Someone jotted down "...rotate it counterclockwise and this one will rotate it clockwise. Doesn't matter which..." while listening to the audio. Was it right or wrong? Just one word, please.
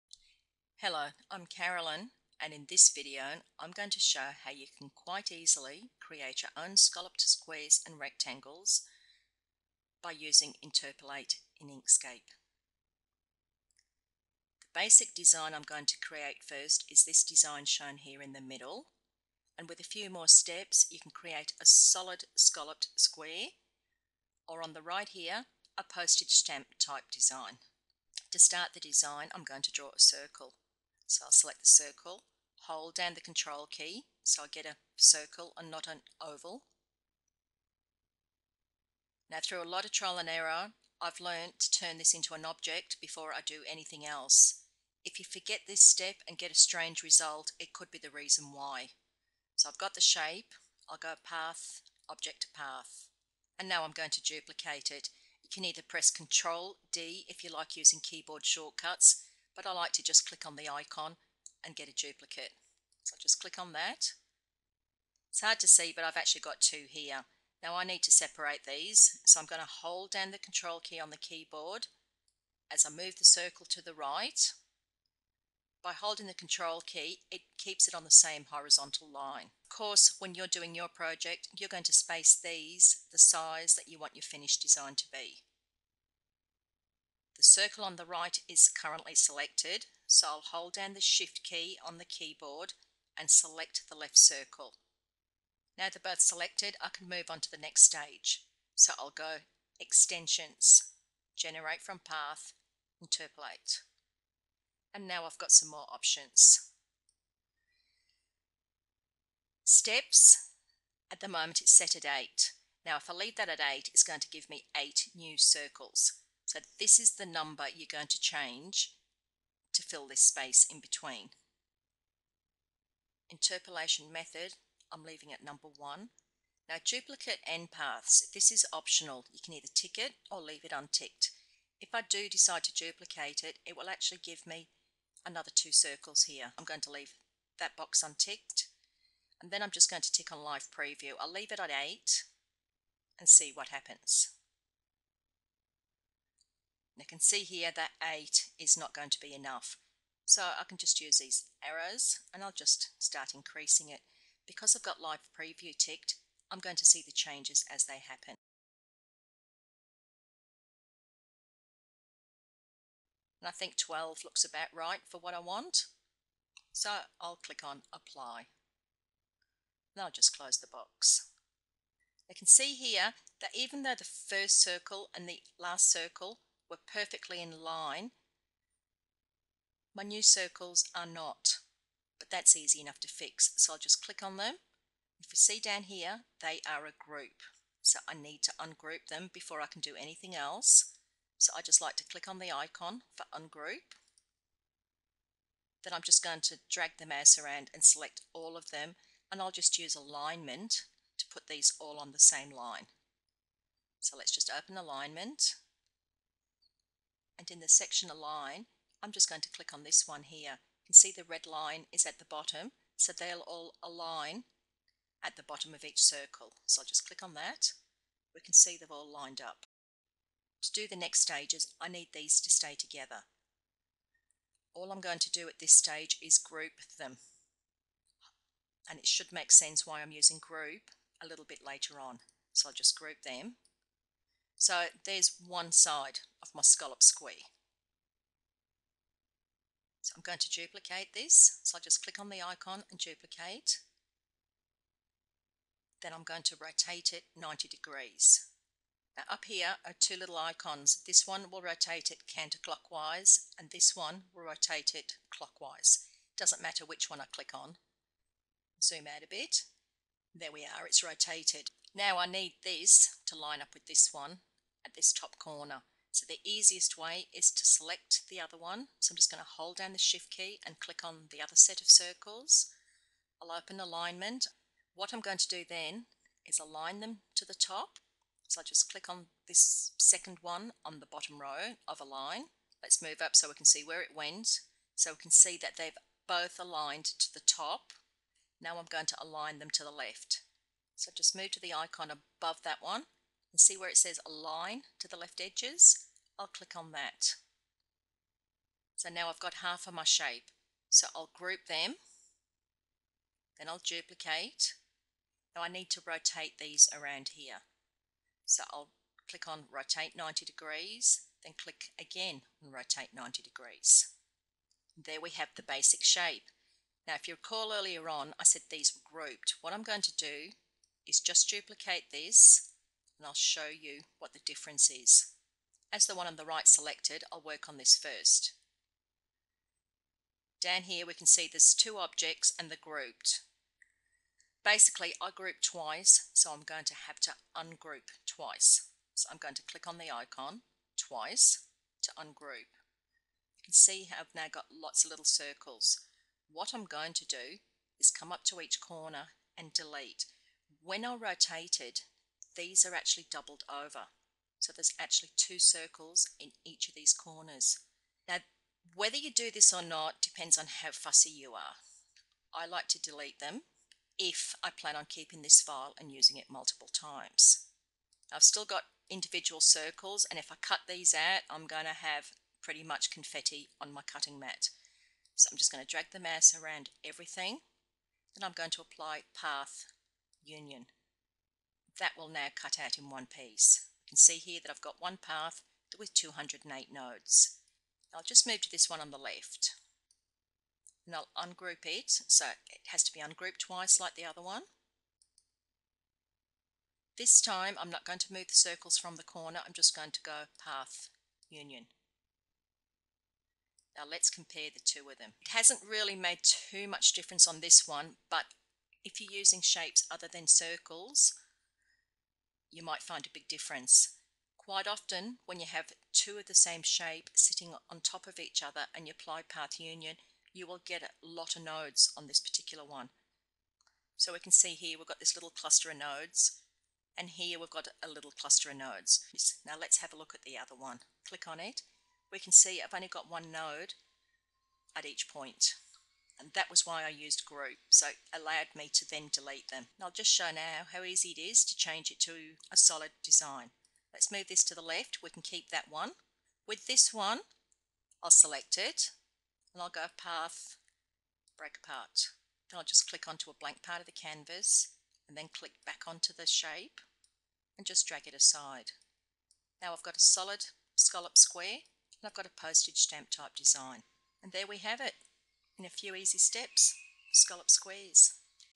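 right.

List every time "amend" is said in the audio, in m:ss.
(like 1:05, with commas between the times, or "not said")
not said.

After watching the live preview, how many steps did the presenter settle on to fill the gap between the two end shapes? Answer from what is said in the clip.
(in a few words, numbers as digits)
12.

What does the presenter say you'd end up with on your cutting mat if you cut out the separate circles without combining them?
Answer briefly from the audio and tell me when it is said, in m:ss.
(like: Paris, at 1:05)
Confetti, at 6:13.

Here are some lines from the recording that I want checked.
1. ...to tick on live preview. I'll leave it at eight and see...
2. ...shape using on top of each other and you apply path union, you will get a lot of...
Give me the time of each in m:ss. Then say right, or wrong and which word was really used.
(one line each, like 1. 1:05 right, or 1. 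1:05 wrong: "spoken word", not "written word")
1. 2:20 right
2. 6:56 wrong: "sitting", not "using".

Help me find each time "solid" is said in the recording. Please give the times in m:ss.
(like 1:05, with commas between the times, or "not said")
0:21, 7:22, 7:40.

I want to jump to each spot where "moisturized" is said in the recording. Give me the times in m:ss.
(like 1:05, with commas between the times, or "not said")
not said.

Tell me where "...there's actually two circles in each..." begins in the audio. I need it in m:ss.
5:54.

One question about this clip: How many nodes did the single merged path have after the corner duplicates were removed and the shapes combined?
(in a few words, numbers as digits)
208.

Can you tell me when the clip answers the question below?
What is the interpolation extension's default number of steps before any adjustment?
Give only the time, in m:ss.
1:51.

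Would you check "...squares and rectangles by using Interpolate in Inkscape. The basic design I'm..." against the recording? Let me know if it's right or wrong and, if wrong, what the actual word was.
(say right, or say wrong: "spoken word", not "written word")
right.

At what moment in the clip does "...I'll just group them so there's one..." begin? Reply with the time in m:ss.
3:52.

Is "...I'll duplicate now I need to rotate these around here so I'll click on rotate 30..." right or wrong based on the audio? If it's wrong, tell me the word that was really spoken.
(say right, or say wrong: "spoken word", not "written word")
wrong: "90", not "30".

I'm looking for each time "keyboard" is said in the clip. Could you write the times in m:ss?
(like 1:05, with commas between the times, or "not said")
0:58, 1:11, 1:32.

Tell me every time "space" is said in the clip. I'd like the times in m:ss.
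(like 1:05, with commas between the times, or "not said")
1:21, 2:00.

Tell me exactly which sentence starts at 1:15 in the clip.
By holding the control key, it keeps it on the same horizontal line.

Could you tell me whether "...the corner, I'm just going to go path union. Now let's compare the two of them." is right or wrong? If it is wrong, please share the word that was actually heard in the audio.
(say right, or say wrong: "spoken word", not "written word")
right.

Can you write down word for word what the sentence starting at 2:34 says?
Because I've got live preview ticked, I'm going to see the changes as they happen.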